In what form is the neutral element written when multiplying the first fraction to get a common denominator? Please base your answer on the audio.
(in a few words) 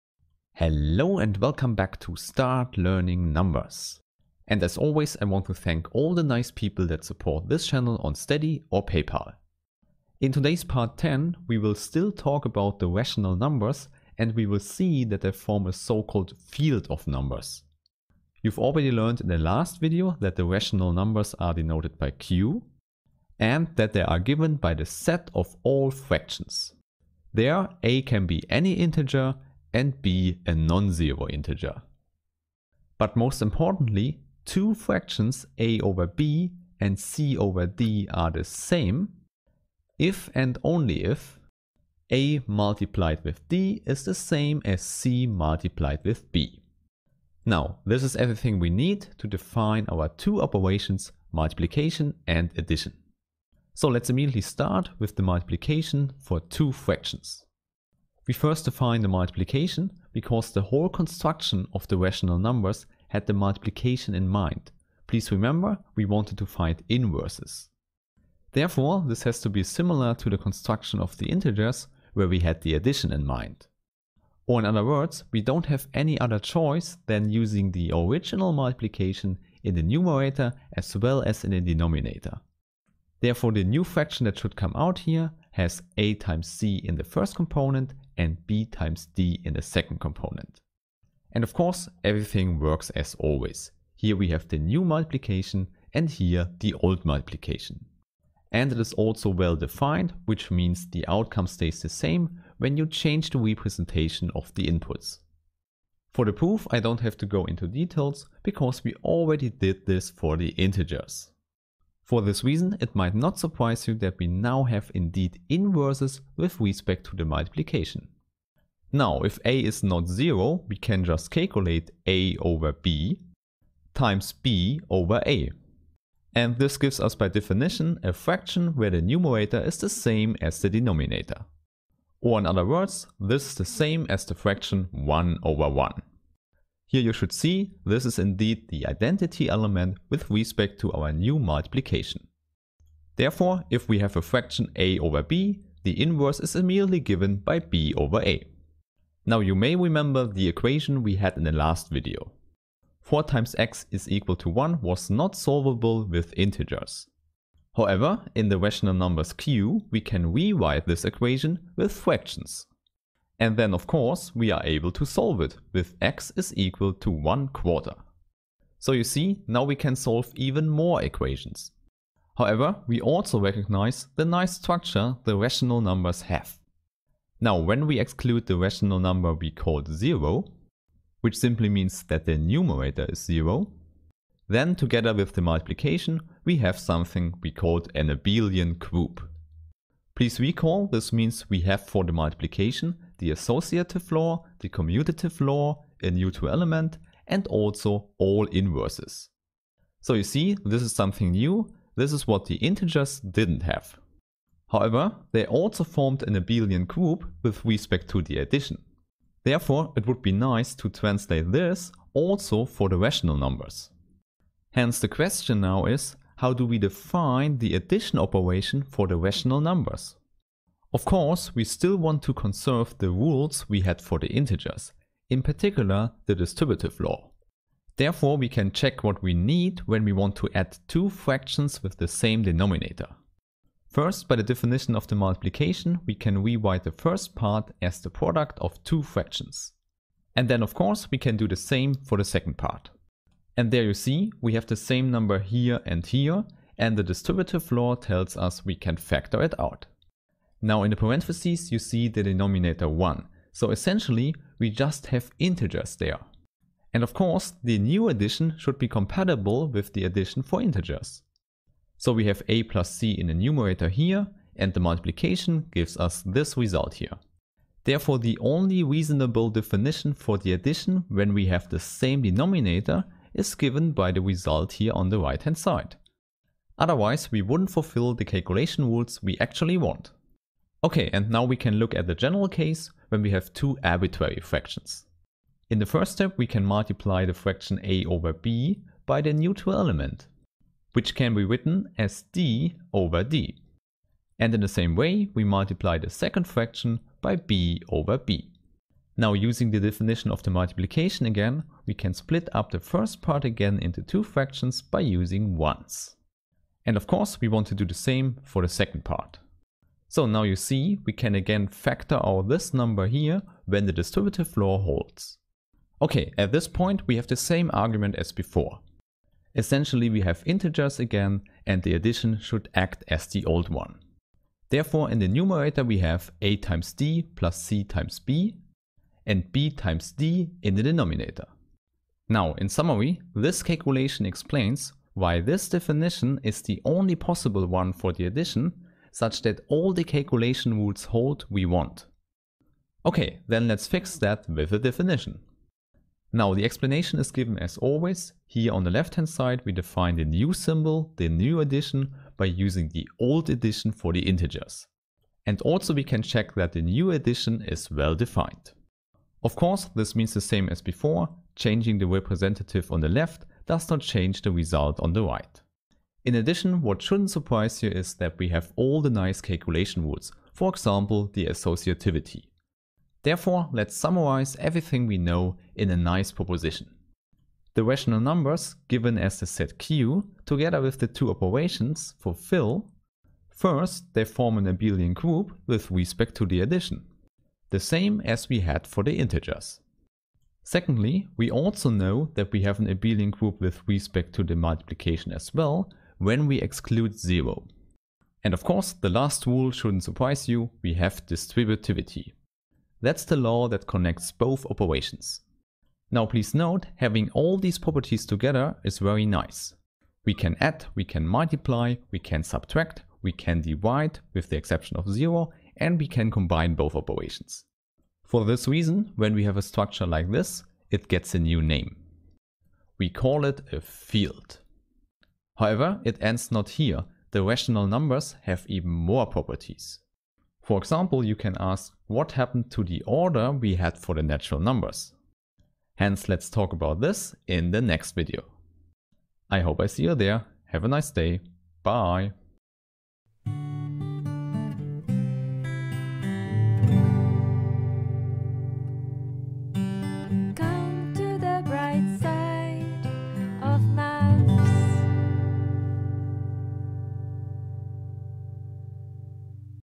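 d over d.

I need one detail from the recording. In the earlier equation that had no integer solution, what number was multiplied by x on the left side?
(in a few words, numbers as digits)
4.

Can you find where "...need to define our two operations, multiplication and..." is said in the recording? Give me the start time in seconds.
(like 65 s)
48 s.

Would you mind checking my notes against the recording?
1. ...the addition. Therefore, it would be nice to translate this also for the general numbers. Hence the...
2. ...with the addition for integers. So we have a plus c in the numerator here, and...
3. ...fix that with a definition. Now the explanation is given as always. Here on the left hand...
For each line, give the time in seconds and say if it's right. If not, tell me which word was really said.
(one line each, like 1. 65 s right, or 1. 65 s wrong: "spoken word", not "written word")
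1. 208 s wrong: "rational", not "general"
2. 259 s right
3. 343 s right.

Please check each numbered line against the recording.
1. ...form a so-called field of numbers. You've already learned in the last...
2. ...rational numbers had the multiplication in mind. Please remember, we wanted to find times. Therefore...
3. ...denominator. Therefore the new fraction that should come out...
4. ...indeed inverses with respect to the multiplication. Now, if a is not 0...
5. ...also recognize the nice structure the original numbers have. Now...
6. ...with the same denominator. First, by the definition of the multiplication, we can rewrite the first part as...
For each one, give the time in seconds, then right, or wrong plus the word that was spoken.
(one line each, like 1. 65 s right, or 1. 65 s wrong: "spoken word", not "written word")
1. 15 s right
2. 61 s wrong: "inverses", not "times"
3. 81 s right
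4. 114 s right
5. 172 s wrong: "rational", not "original"
6. 231 s right.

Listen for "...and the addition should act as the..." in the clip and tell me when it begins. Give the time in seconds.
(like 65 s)
321 s.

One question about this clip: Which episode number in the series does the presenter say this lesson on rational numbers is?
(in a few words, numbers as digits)
Part 10.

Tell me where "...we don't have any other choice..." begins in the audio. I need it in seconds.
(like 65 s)
75 s.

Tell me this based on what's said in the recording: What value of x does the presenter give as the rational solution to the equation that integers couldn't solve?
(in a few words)
1/4.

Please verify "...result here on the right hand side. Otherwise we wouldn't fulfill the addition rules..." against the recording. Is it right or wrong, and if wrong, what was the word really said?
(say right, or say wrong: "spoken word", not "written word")
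wrong: "calculation", not "addition".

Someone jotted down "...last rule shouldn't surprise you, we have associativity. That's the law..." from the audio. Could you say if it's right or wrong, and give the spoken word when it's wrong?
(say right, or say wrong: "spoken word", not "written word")
wrong: "distributivity", not "associativity".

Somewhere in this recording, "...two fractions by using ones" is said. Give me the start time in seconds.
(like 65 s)
304 s.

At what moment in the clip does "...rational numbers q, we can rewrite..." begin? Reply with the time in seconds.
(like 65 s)
158 s.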